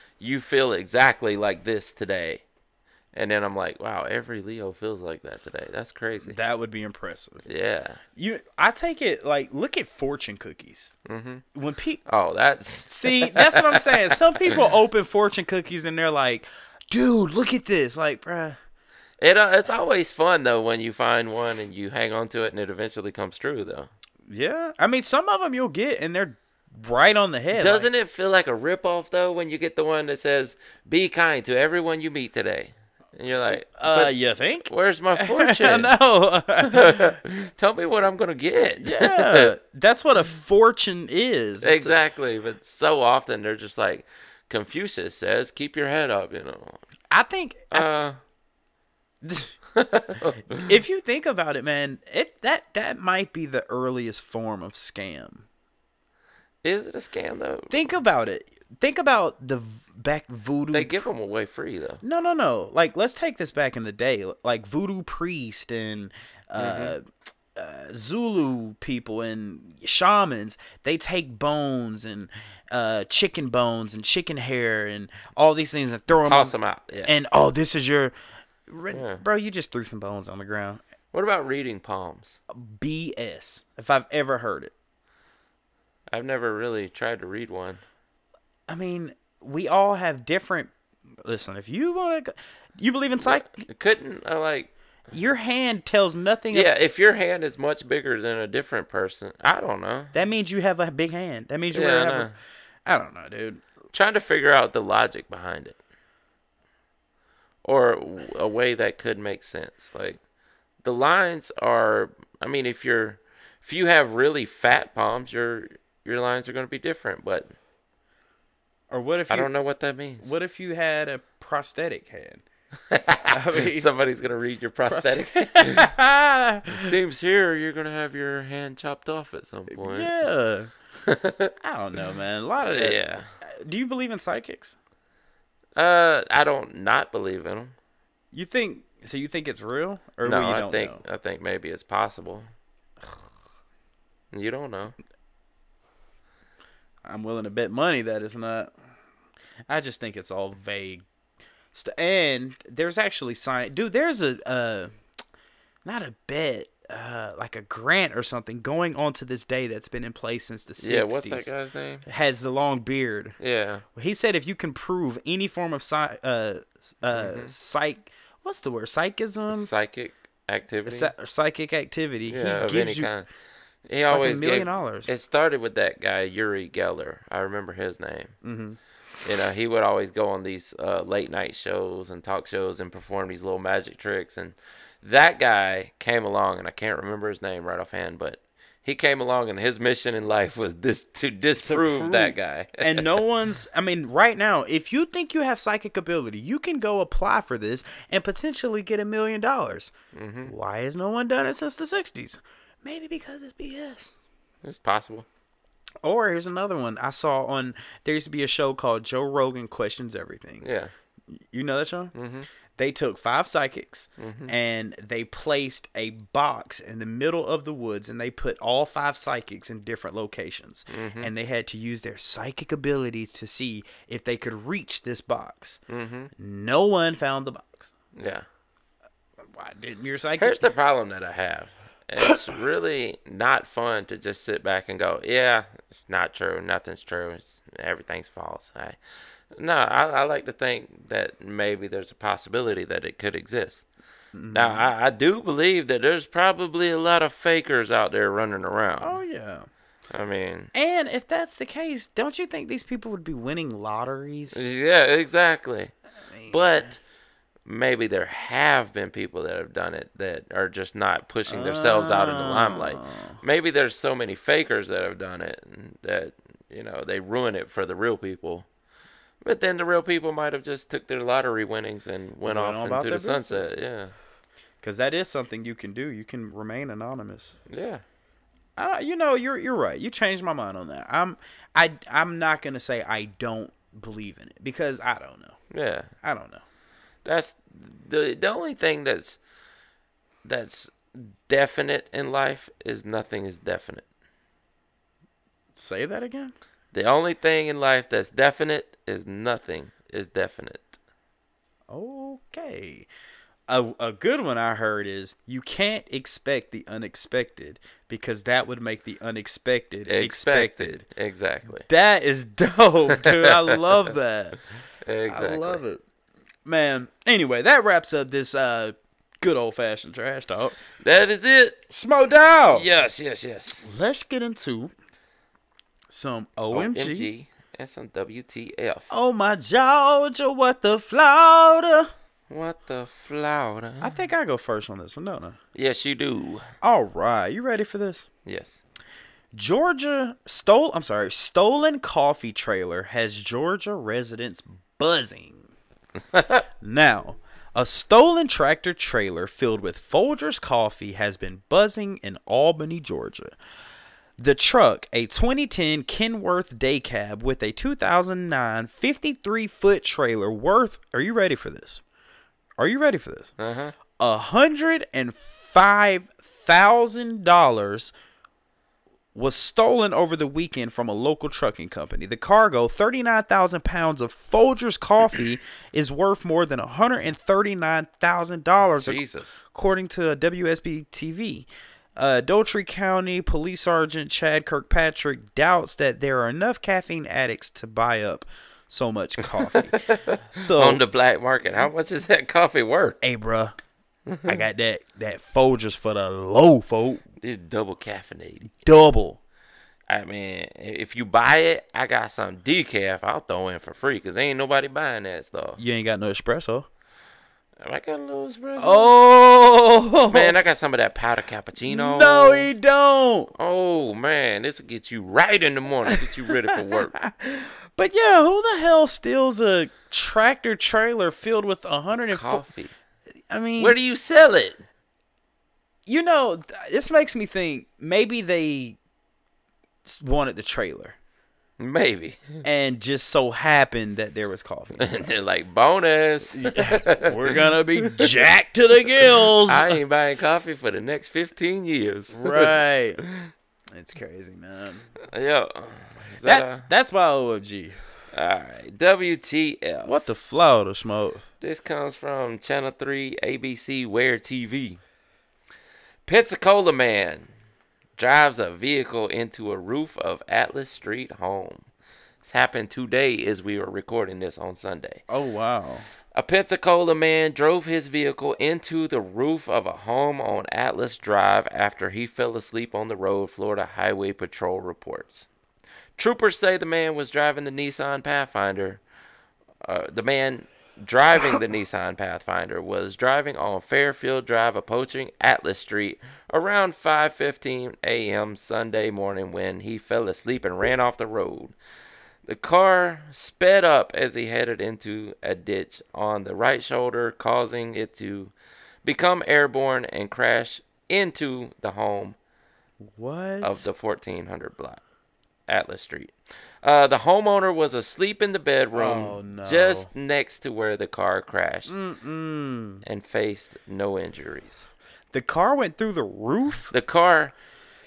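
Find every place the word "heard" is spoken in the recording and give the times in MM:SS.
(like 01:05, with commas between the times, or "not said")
01:24, 05:04.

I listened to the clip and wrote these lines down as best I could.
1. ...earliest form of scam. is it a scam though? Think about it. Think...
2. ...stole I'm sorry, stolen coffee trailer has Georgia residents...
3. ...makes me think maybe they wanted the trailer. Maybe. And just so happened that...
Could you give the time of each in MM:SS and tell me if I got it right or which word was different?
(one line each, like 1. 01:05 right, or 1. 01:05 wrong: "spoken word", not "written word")
1. 00:53 right
2. 05:40 right
3. 07:07 right.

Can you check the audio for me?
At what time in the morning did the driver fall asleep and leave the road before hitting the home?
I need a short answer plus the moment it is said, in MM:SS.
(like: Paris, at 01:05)
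5:15 a.m., at 08:06.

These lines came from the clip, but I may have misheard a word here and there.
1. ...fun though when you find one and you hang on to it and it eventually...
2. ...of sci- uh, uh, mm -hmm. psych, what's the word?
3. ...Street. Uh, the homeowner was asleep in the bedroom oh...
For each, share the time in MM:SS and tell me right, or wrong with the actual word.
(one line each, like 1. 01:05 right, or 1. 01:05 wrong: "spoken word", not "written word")
1. 00:20 right
2. 02:45 right
3. 08:26 right.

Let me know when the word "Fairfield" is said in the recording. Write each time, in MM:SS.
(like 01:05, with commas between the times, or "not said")
08:03.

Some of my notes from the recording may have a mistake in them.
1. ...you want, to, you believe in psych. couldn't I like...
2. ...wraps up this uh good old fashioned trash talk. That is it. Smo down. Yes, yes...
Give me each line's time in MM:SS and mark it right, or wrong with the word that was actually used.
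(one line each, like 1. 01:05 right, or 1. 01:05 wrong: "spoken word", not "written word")
1. 01:31 right
2. 05:17 right.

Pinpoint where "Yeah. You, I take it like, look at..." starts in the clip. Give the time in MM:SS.
00:07.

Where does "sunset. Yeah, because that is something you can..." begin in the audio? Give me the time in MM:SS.
04:33.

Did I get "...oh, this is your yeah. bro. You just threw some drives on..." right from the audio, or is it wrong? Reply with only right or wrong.
wrong.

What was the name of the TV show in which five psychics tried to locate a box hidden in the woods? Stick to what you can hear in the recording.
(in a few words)
Joe Rogan Questions Everything.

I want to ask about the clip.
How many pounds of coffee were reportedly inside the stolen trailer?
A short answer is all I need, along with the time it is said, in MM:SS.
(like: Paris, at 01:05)
39,000, at 06:12.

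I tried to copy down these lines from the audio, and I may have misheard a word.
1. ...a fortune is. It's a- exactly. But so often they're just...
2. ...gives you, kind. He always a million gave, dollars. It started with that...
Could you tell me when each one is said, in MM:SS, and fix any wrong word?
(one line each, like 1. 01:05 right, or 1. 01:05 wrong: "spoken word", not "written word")
1. 00:40 right
2. 02:52 right.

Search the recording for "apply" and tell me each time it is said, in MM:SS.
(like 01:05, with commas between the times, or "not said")
03:16.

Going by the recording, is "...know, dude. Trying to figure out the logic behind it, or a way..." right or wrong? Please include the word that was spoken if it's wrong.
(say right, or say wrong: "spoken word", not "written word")
right.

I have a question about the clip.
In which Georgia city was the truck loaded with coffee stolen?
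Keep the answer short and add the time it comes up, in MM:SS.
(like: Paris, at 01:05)
Albany, at 05:52.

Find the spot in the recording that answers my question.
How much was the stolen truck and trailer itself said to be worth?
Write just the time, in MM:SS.
06:04.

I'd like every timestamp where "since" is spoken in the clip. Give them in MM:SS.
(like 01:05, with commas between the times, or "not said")
02:40, 03:21.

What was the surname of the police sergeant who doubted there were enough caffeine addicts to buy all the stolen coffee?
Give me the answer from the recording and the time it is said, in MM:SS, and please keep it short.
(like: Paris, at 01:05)
Kirkpatrick, at 06:24.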